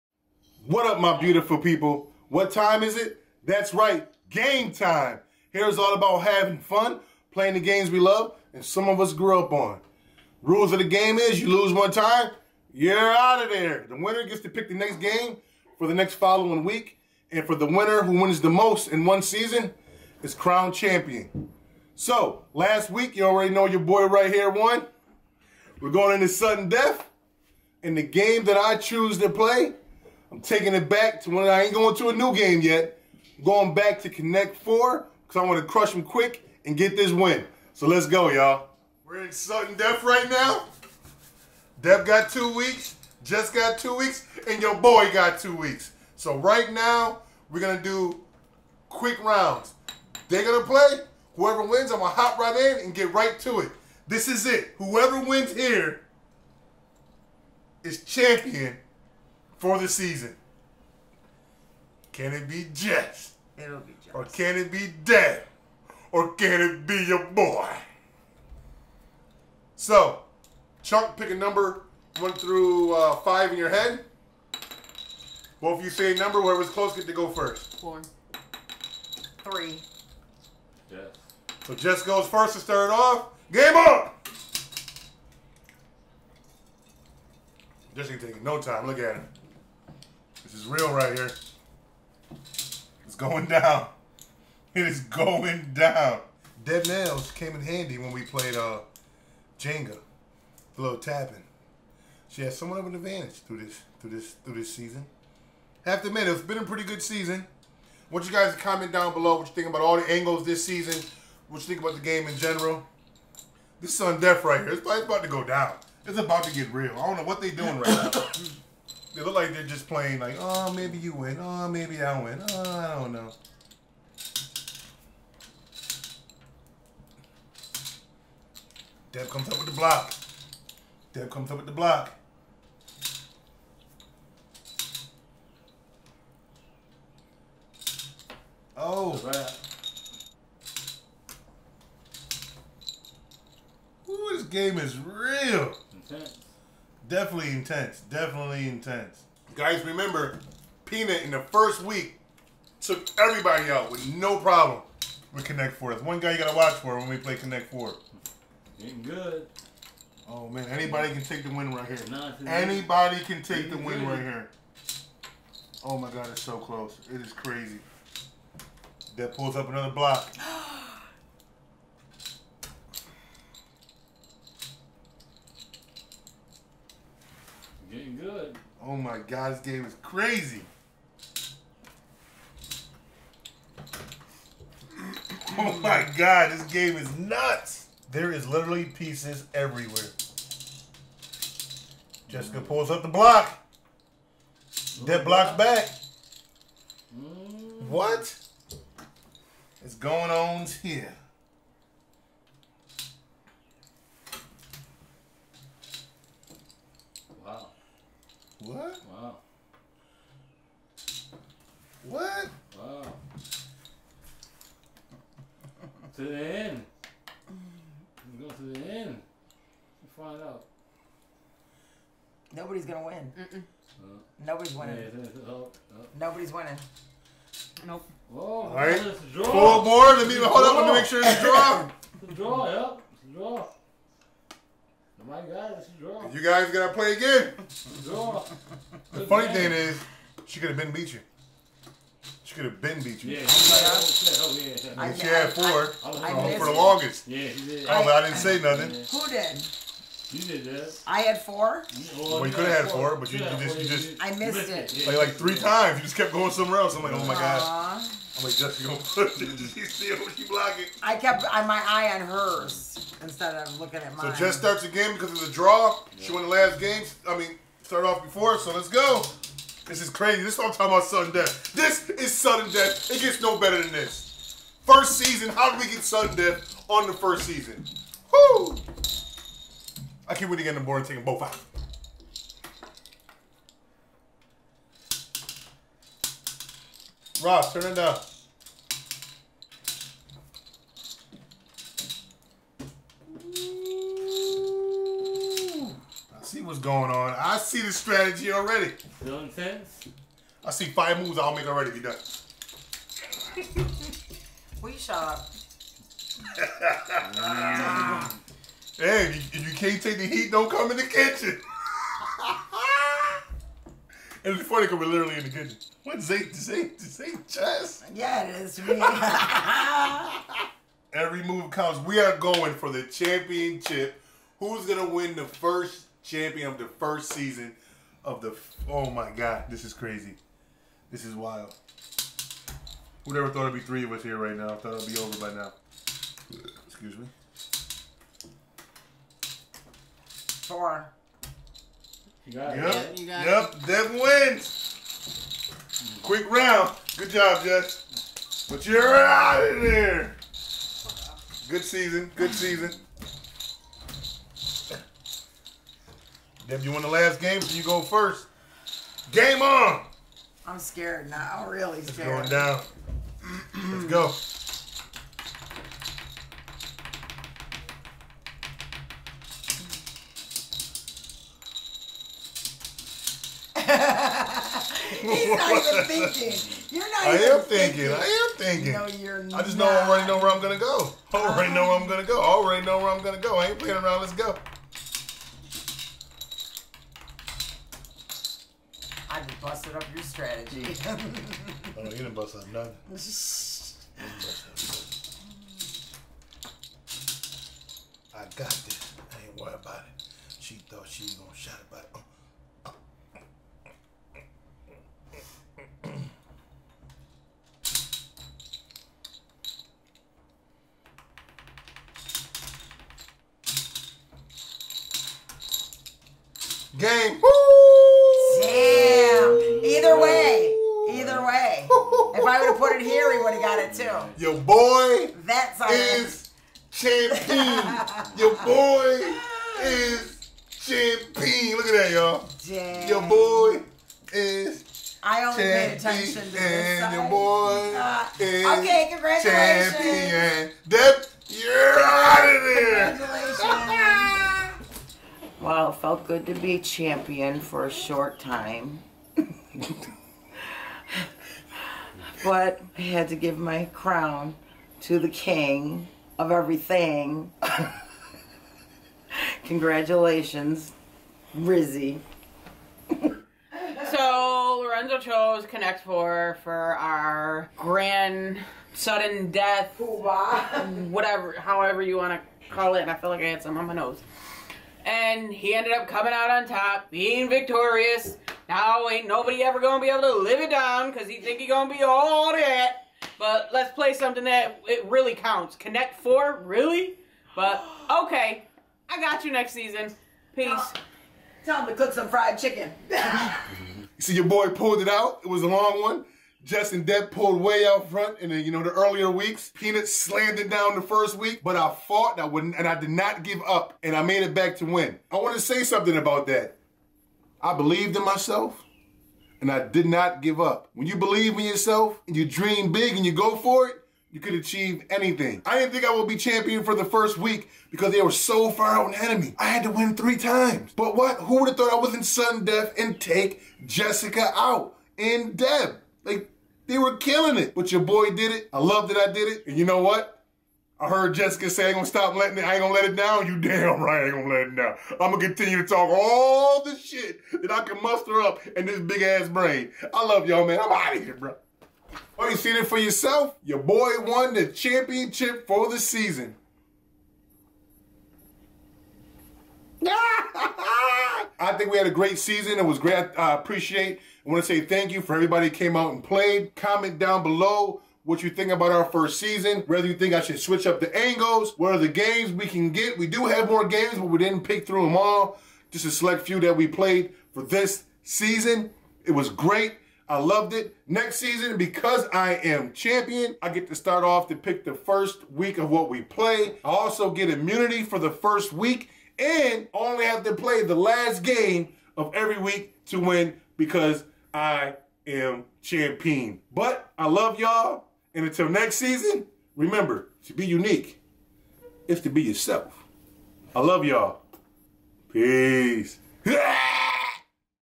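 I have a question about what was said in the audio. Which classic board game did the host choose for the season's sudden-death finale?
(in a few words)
Connect 4.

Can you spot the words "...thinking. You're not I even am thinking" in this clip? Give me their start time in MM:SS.
06:16.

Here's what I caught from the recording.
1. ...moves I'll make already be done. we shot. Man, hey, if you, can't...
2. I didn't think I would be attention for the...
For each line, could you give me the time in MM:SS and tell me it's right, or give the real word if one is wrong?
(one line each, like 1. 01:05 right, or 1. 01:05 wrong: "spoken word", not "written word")
1. 05:01 right
2. 08:35 wrong: "champion", not "attention".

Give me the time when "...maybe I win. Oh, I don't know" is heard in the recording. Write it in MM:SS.
02:01.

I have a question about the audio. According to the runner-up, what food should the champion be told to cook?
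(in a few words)
Fried chicken.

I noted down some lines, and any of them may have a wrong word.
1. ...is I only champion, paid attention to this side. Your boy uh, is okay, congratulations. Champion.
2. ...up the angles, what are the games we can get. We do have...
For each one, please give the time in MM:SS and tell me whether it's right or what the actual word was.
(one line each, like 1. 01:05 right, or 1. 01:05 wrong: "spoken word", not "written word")
1. 07:14 right
2. 09:20 right.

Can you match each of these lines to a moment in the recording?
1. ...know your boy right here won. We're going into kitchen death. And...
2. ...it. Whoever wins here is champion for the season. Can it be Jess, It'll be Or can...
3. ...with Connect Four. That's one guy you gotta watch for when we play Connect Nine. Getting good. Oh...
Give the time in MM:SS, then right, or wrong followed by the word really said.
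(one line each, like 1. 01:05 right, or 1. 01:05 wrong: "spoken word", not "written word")
1. 00:23 wrong: "sudden", not "kitchen"
2. 00:54 right
3. 02:35 wrong: "Four", not "Nine".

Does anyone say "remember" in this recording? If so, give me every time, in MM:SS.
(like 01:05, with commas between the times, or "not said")
02:29, 09:49.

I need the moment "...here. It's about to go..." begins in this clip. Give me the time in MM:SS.
01:54.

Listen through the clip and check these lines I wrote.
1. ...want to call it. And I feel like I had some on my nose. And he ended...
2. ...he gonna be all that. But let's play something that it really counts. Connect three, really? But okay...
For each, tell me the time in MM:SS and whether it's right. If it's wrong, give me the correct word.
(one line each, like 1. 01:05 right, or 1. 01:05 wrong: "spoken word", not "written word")
1. 07:52 right
2. 08:01 wrong: "four", not "three".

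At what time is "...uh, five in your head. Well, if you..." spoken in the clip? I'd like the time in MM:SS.
01:12.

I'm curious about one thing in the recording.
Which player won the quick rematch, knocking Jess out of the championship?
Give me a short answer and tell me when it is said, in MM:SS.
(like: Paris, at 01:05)
Devin, at 05:43.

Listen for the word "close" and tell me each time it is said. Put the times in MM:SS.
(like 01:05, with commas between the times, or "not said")
01:16, 02:46.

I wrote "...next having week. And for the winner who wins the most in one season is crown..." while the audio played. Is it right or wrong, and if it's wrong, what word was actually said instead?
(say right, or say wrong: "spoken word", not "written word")
wrong: "following", not "having".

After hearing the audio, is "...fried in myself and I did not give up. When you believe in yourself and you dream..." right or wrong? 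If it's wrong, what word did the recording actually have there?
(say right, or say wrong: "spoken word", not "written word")
wrong: "believed", not "fried".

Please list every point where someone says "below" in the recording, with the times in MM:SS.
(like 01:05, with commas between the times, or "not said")
01:49, 09:17.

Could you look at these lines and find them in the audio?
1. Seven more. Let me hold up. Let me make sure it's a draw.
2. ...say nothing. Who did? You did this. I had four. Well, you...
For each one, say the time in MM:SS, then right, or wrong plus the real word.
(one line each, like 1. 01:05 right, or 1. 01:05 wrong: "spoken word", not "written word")
1. 03:49 wrong: "Four", not "Seven"
2. 04:08 right.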